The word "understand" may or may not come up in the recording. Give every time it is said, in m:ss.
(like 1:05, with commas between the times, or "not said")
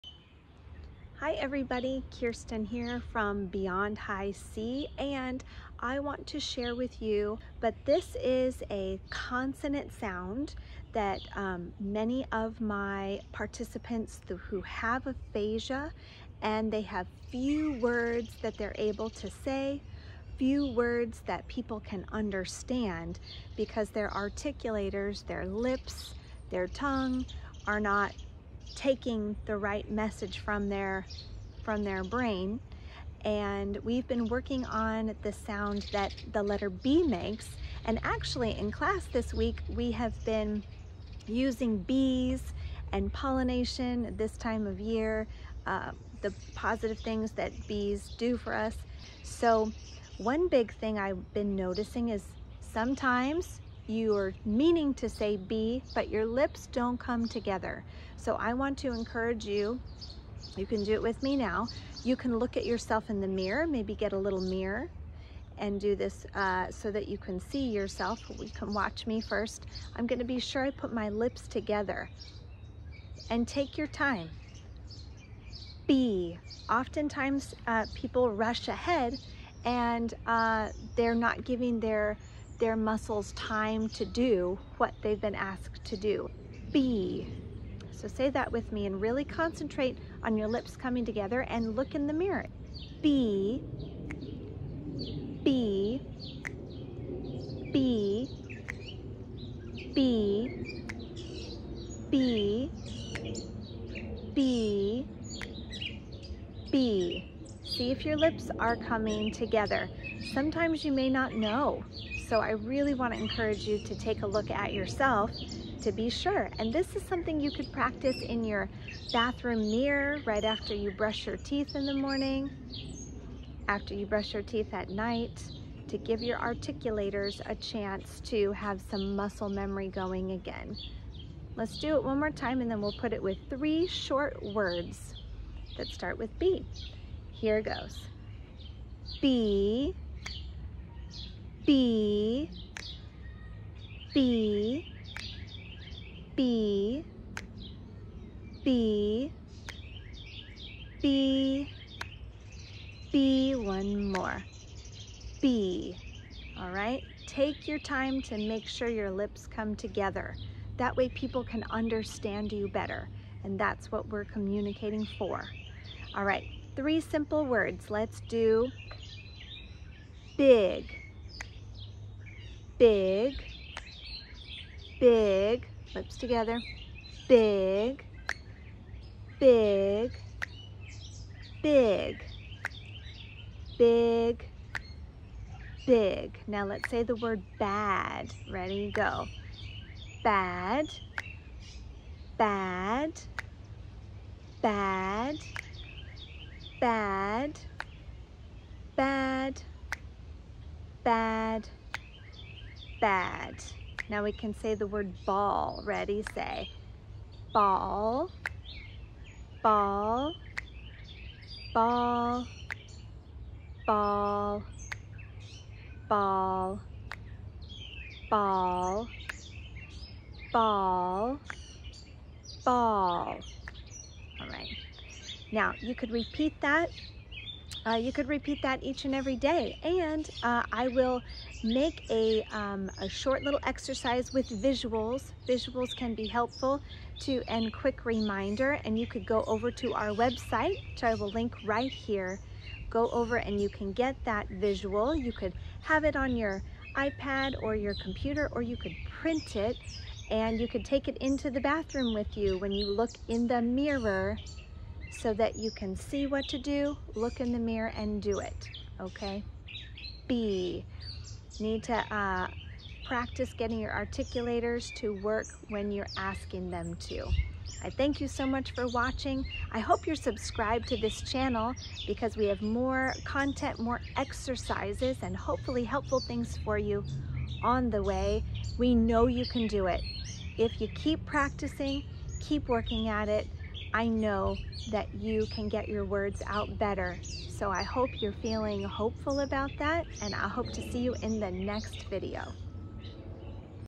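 0:22, 2:41.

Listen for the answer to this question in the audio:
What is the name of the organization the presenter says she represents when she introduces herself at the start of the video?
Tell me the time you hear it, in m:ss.
0:03.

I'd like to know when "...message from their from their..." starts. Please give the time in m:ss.
0:29.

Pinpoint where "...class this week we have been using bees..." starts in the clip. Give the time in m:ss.
0:38.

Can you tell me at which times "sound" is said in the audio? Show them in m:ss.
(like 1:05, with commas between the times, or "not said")
0:09, 0:35.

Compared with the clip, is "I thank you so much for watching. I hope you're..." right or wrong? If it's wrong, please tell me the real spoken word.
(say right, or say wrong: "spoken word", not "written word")
right.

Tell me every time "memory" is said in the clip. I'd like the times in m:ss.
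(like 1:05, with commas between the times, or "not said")
2:09.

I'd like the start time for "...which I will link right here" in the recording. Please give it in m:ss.
4:00.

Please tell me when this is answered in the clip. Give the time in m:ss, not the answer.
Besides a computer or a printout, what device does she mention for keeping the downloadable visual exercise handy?
4:06.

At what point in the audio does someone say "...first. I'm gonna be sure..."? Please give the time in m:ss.
1:09.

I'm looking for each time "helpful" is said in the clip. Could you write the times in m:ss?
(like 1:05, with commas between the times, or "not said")
3:56, 4:35.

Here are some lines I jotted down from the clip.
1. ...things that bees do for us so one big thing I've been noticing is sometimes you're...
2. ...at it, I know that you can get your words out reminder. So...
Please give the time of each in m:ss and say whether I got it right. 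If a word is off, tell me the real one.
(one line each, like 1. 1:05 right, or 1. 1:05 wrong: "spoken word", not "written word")
1. 0:46 right
2. 4:43 wrong: "better", not "reminder".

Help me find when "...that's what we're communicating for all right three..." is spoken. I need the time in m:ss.
2:43.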